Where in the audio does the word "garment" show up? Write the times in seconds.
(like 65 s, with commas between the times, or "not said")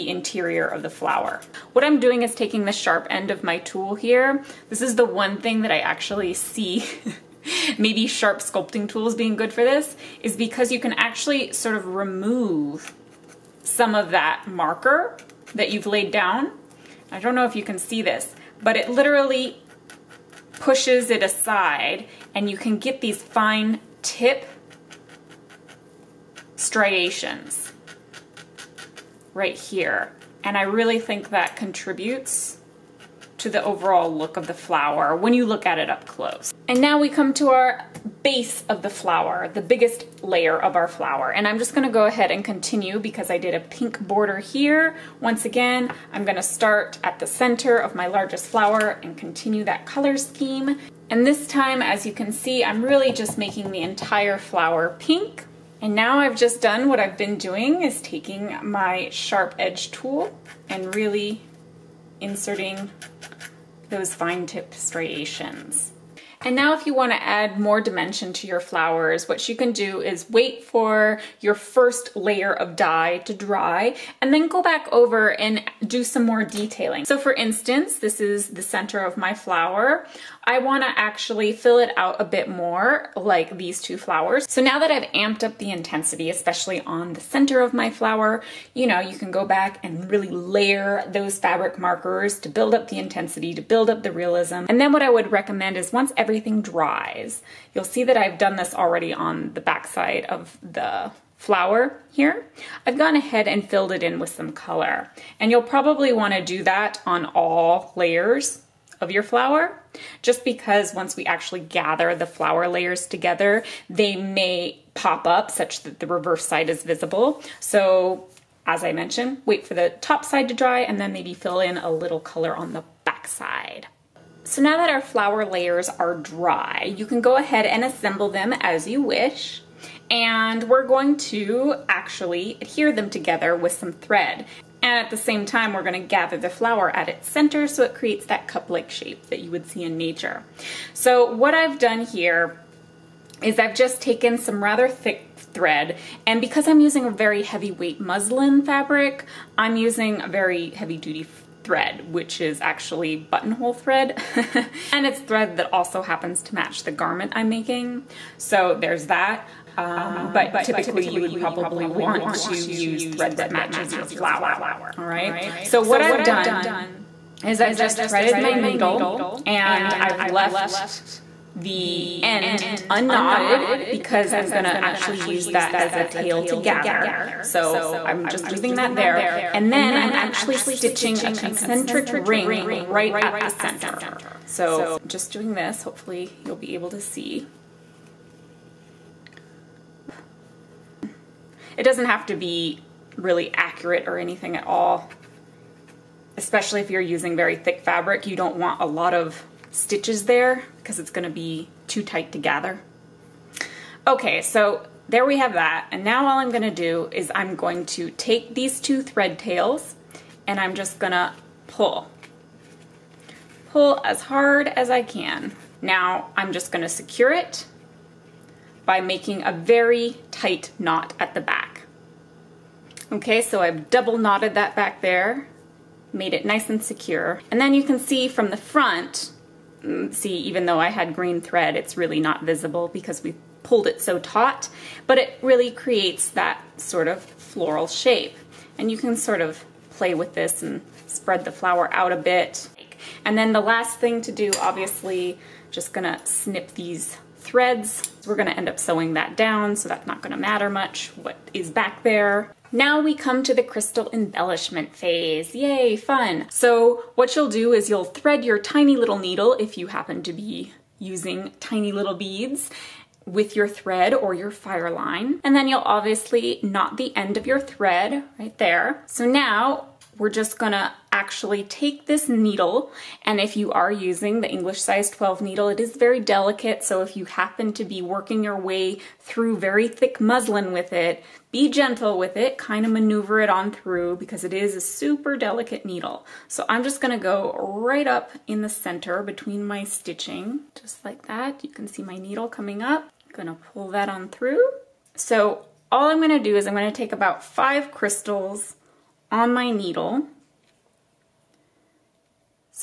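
156 s.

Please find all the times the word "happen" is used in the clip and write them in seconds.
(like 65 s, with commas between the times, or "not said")
156 s, 259 s, 277 s.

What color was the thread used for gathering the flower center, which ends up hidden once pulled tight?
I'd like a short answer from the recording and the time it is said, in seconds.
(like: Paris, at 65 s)
green, at 231 s.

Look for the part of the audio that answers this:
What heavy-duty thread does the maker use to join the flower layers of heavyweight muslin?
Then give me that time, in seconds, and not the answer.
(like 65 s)
153 s.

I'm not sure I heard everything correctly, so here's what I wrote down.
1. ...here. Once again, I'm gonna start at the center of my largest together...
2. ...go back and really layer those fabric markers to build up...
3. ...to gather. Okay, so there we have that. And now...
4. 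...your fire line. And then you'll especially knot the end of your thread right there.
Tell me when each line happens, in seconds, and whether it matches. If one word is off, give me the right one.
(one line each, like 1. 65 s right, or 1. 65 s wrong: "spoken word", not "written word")
1. 44 s wrong: "flower", not "together"
2. 89 s right
3. 202 s right
4. 264 s wrong: "obviously", not "especially".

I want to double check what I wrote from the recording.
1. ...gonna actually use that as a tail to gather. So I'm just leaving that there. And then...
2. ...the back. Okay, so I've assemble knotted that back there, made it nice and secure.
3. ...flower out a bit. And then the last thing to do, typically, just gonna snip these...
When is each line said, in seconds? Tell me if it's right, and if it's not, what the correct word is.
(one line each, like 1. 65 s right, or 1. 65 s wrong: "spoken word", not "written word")
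1. 174 s right
2. 221 s wrong: "double", not "assemble"
3. 241 s wrong: "obviously", not "typically".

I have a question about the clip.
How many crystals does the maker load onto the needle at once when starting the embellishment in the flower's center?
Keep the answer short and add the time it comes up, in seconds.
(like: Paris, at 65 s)
5, at 297 s.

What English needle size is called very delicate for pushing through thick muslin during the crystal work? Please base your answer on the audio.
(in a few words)
12.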